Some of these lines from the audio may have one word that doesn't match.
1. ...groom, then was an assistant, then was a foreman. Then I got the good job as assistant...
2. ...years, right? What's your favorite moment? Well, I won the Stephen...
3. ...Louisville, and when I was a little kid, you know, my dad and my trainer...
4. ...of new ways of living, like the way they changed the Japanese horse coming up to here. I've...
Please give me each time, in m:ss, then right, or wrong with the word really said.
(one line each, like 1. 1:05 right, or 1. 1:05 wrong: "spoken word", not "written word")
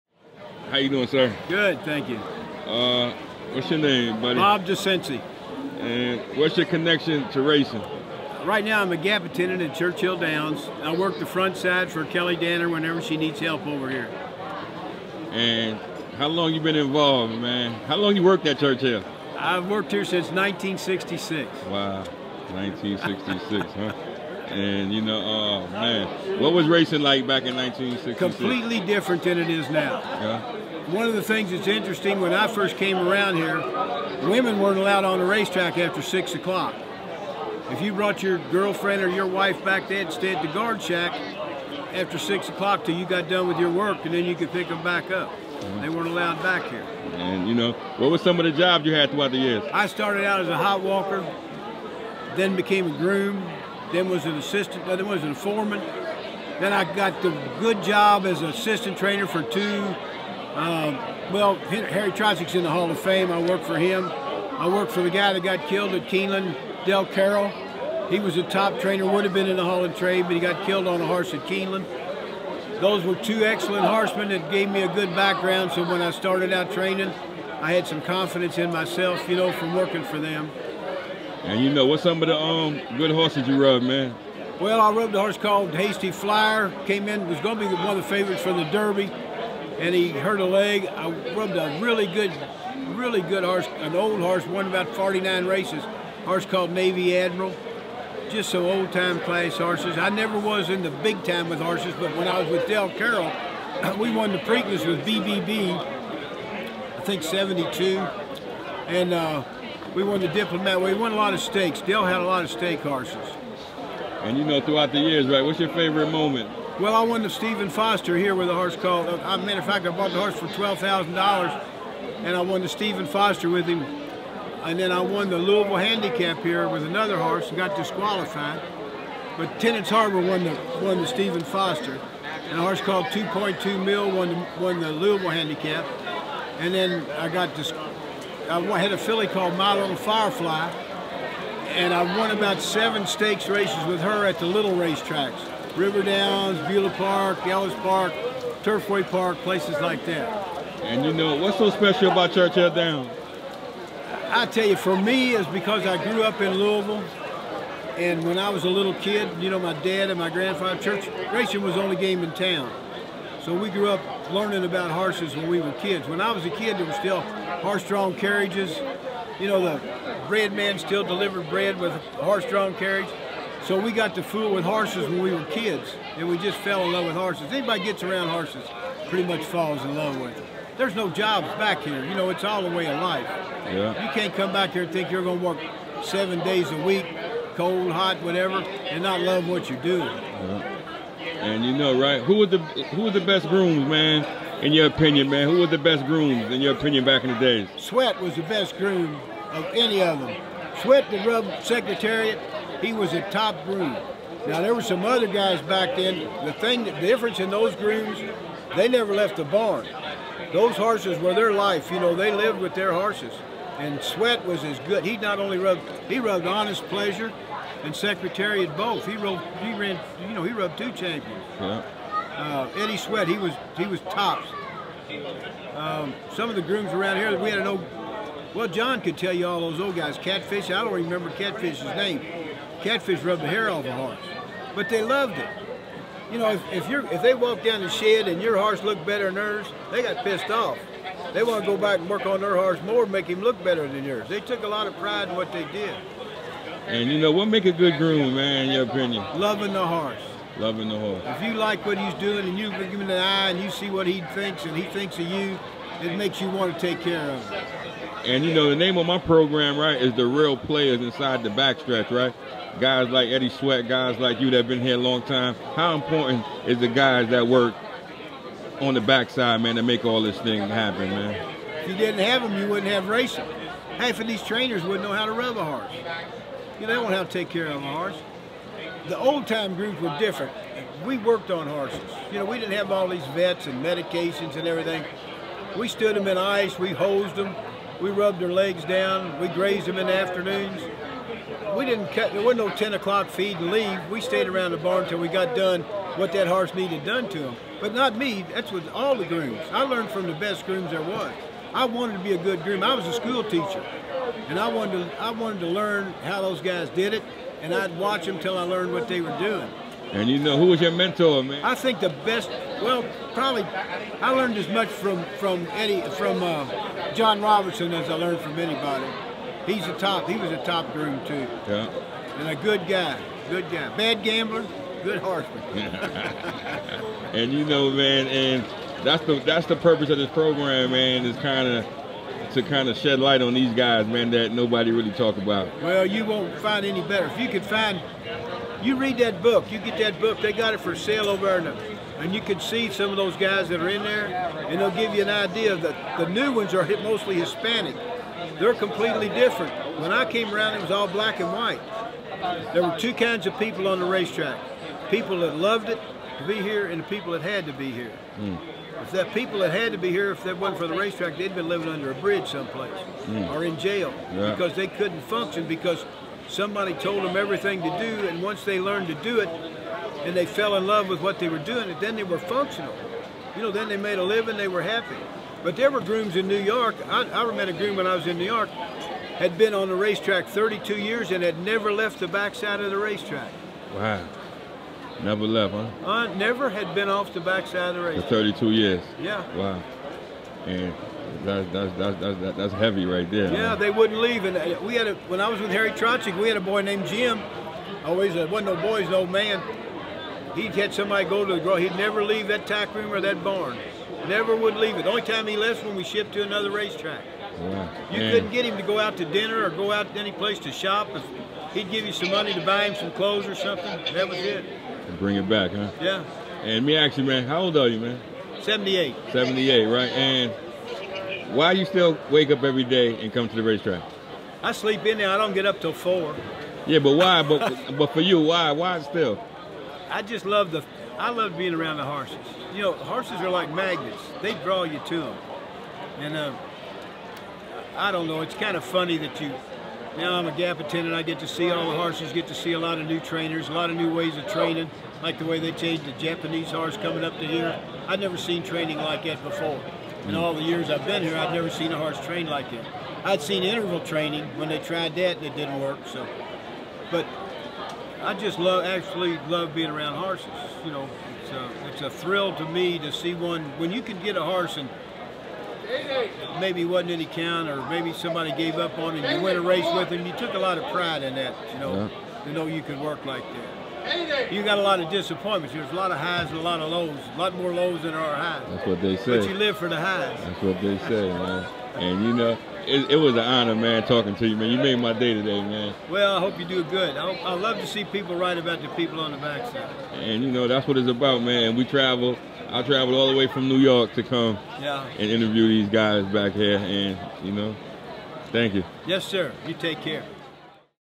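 1. 0:53 right
2. 1:54 right
3. 2:36 wrong: "grandfather", not "trainer"
4. 7:23 wrong: "training", not "living".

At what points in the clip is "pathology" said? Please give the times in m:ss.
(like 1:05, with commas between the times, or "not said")
not said.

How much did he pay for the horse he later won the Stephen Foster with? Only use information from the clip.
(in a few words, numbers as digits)
$12,000.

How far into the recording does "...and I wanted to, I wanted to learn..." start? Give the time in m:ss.
5:04.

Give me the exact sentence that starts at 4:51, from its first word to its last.
We didn't cut, there wasn't no 10 o'clock feed and leave.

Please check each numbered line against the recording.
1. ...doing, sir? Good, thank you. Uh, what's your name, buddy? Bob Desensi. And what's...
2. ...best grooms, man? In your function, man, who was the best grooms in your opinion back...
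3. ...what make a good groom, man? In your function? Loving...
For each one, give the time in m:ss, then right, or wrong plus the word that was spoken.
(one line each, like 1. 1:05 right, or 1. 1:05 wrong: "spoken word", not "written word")
1. 0:00 right
2. 3:13 wrong: "opinion", not "function"
3. 4:07 wrong: "opinion", not "function".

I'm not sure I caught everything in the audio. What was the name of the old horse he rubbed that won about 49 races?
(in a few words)
Navy Admiral.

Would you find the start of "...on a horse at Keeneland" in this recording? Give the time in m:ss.
1:10.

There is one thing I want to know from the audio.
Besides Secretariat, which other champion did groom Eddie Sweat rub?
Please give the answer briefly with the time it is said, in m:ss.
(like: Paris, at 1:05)
Honest Pleasure, at 3:36.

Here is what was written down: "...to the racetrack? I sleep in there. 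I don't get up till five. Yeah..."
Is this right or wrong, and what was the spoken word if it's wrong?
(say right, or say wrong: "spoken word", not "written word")
wrong: "four", not "five".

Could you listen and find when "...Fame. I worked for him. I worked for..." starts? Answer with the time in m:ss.
1:02.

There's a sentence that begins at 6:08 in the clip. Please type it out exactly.
And once they learned to do it and they fell in love with what they were doing, and then they were functional.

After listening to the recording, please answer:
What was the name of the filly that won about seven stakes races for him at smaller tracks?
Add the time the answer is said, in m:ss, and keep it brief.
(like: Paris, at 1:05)
My Little Firefly, at 2:19.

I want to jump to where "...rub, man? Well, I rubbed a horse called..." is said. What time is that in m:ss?
1:23.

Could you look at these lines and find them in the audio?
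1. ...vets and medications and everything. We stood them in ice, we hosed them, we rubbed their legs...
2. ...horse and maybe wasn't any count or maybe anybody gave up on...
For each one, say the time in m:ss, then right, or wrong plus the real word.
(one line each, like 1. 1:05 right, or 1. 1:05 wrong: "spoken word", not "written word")
1. 4:43 right
2. 7:44 wrong: "somebody", not "anybody".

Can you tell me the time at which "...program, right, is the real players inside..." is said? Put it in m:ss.
4:19.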